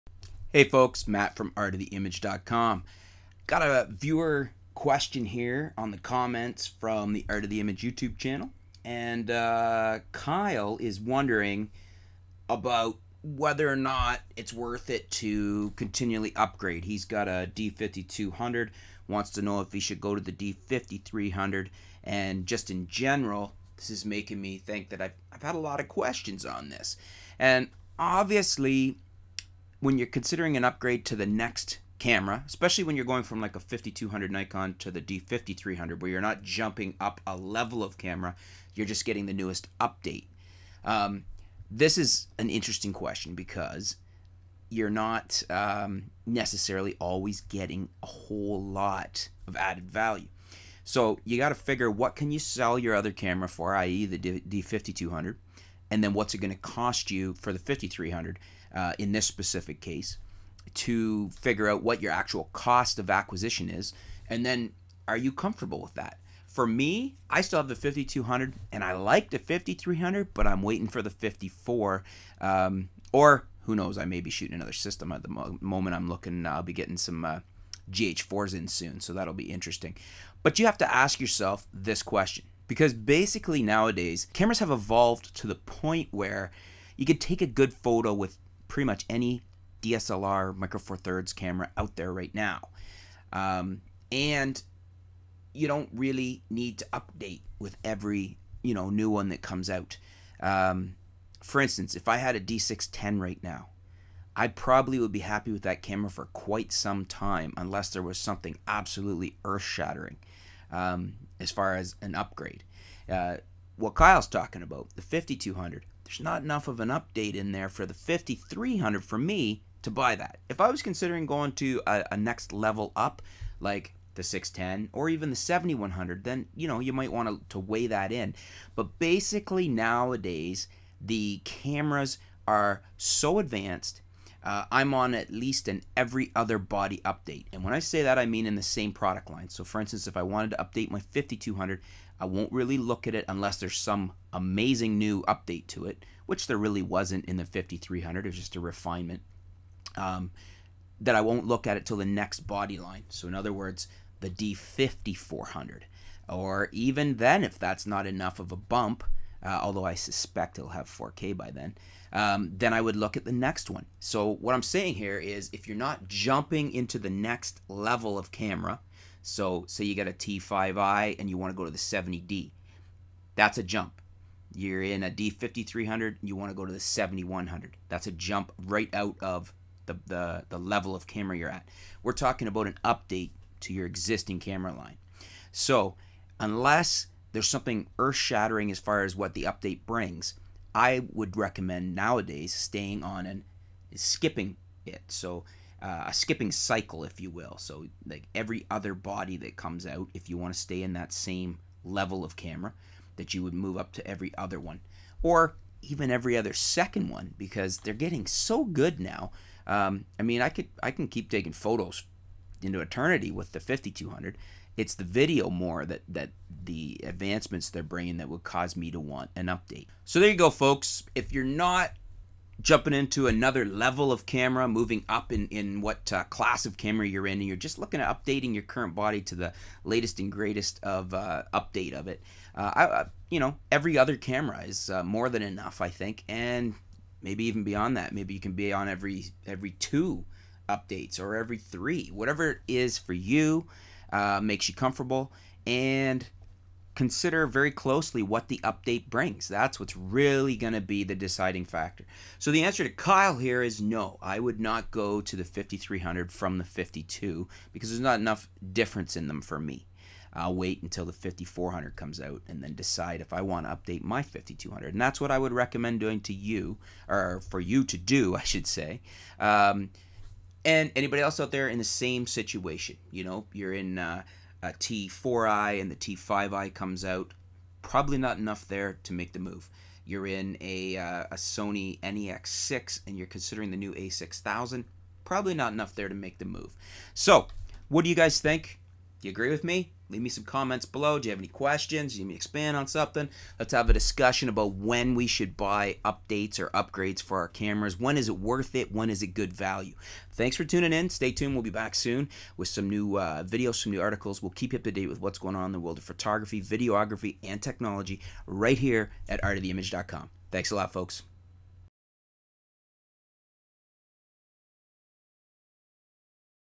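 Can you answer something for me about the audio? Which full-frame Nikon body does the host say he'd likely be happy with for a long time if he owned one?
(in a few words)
D610.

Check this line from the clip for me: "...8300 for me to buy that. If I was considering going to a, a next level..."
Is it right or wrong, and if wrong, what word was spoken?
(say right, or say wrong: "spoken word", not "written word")
wrong: "5300", not "8300".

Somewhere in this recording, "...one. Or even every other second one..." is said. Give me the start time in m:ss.
3:24.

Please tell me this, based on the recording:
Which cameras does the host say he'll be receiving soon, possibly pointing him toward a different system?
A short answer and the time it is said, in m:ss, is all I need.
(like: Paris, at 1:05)
GH4s, at 1:17.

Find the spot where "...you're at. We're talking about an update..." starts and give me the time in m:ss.
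3:01.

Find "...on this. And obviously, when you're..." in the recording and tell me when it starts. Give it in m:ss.
0:26.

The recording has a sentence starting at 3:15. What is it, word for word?
So, uh, a skipping cycle, if you will.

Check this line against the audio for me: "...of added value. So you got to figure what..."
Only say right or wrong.
right.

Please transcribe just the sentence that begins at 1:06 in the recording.
For me, I still have the 5200 and I like the 5300, but I'm waiting for the 54.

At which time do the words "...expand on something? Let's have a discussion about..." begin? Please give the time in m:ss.
4:52.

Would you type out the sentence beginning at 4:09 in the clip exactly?
That's what's really going to be the deciding factor.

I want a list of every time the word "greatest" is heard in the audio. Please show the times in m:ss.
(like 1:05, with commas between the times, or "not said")
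3:50.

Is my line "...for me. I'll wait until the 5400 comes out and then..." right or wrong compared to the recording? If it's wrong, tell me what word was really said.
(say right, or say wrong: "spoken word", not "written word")
right.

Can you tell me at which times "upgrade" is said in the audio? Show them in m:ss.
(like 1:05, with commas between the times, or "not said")
0:16, 0:30, 1:52, 4:56.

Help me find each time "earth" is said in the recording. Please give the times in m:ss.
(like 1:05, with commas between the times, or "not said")
1:49, 3:07.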